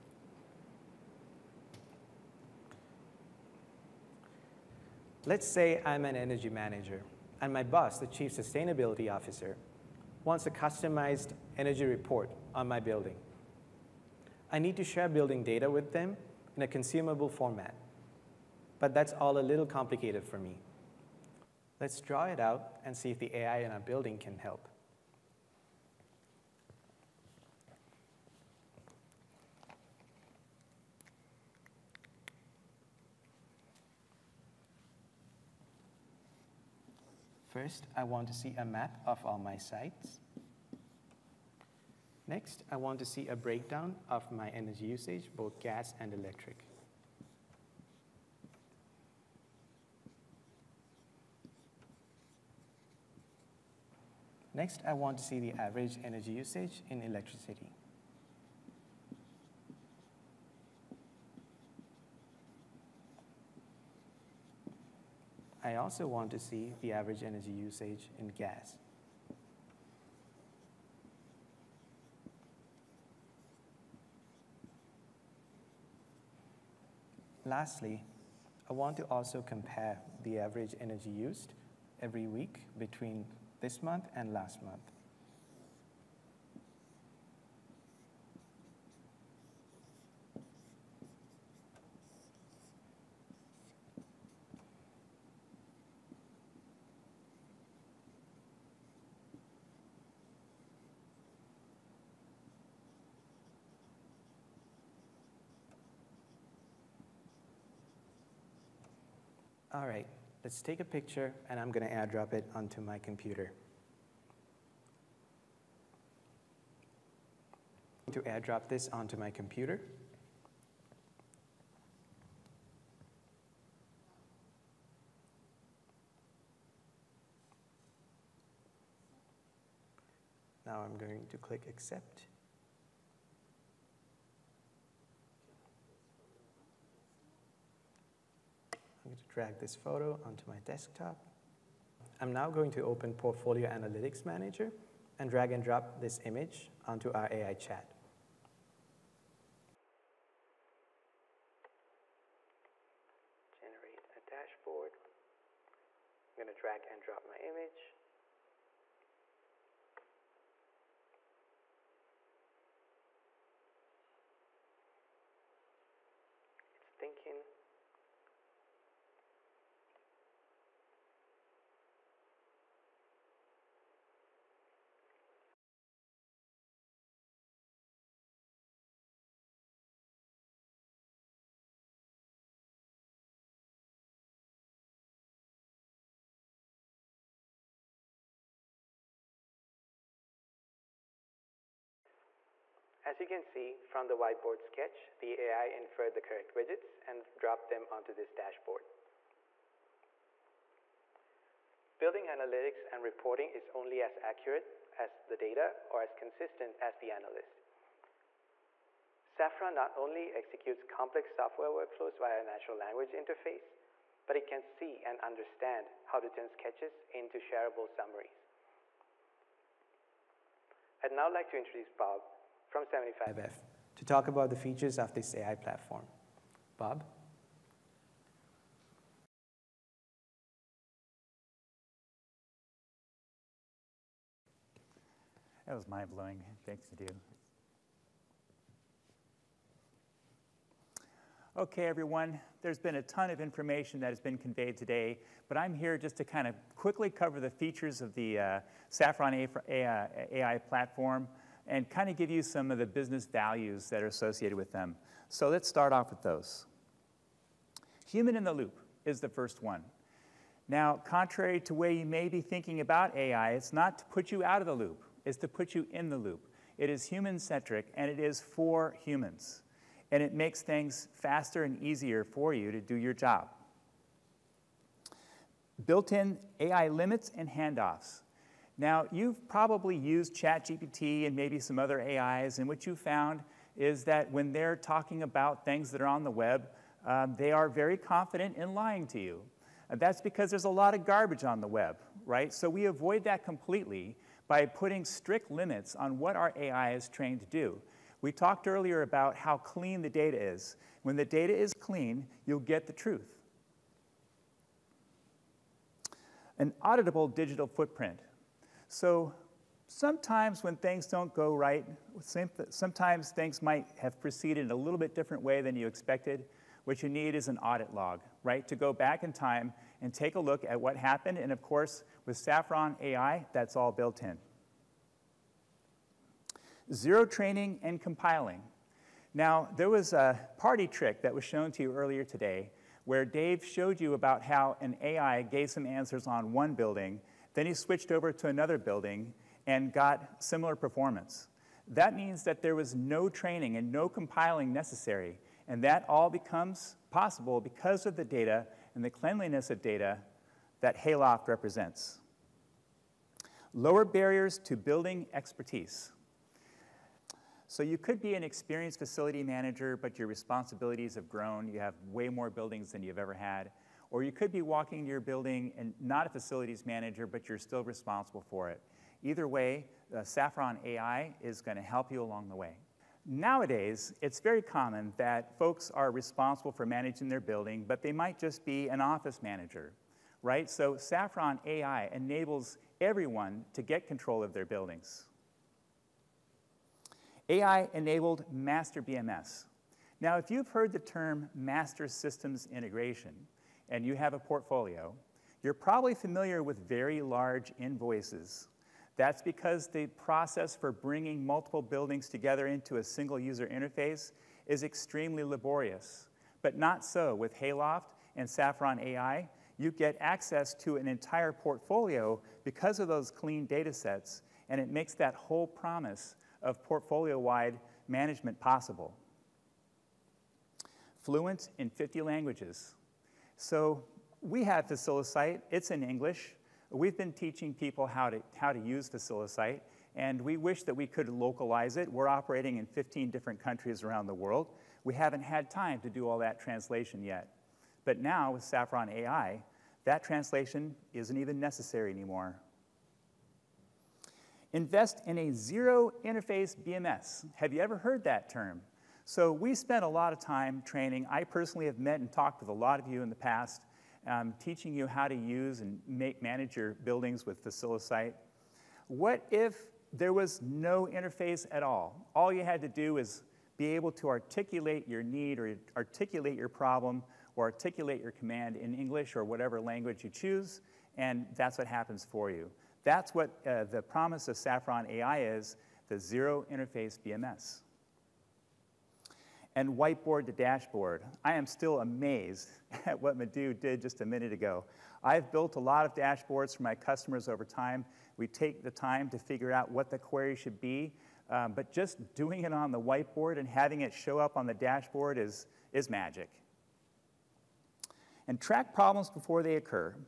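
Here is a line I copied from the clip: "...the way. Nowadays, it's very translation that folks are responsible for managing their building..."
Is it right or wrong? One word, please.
wrong.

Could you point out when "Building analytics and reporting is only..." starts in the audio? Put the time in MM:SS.
03:21.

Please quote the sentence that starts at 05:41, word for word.
That means that there was no training and no compiling necessary.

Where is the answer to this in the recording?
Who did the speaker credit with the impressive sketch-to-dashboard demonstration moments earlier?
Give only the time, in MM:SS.
08:03.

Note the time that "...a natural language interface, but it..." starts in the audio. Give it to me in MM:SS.
03:32.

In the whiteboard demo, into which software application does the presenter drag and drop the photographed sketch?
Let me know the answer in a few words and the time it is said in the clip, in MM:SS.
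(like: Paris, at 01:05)
Portfolio Analytics Manager, at 02:23.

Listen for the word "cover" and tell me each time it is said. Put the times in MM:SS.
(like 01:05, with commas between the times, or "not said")
04:07.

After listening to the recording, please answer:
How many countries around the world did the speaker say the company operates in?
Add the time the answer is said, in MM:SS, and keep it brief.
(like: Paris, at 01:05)
15, at 07:12.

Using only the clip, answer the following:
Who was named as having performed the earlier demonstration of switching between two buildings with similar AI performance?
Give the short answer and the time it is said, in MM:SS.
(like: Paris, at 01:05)
Dave, at 05:33.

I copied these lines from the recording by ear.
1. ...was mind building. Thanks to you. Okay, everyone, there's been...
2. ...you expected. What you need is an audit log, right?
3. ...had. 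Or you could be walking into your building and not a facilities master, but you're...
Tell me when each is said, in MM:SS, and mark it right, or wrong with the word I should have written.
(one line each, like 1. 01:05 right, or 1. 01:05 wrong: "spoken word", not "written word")
1. 03:55 wrong: "blowing", not "building"
2. 05:15 right
3. 06:03 wrong: "manager", not "master".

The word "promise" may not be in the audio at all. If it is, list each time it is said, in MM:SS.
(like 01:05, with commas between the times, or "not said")
06:55, 07:54.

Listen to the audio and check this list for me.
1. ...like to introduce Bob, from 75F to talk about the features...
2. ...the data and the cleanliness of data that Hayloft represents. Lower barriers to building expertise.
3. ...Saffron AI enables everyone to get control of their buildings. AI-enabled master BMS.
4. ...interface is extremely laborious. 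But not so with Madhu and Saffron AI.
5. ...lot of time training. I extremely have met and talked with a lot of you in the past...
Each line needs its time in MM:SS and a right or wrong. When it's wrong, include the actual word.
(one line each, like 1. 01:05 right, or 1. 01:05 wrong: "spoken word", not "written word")
1. 03:41 right
2. 05:48 right
3. 06:20 right
4. 06:43 wrong: "Hayloft", not "Madhu"
5. 07:30 wrong: "personally", not "extremely".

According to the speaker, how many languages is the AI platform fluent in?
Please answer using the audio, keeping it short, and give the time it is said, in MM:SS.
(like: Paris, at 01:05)
50, at 07:01.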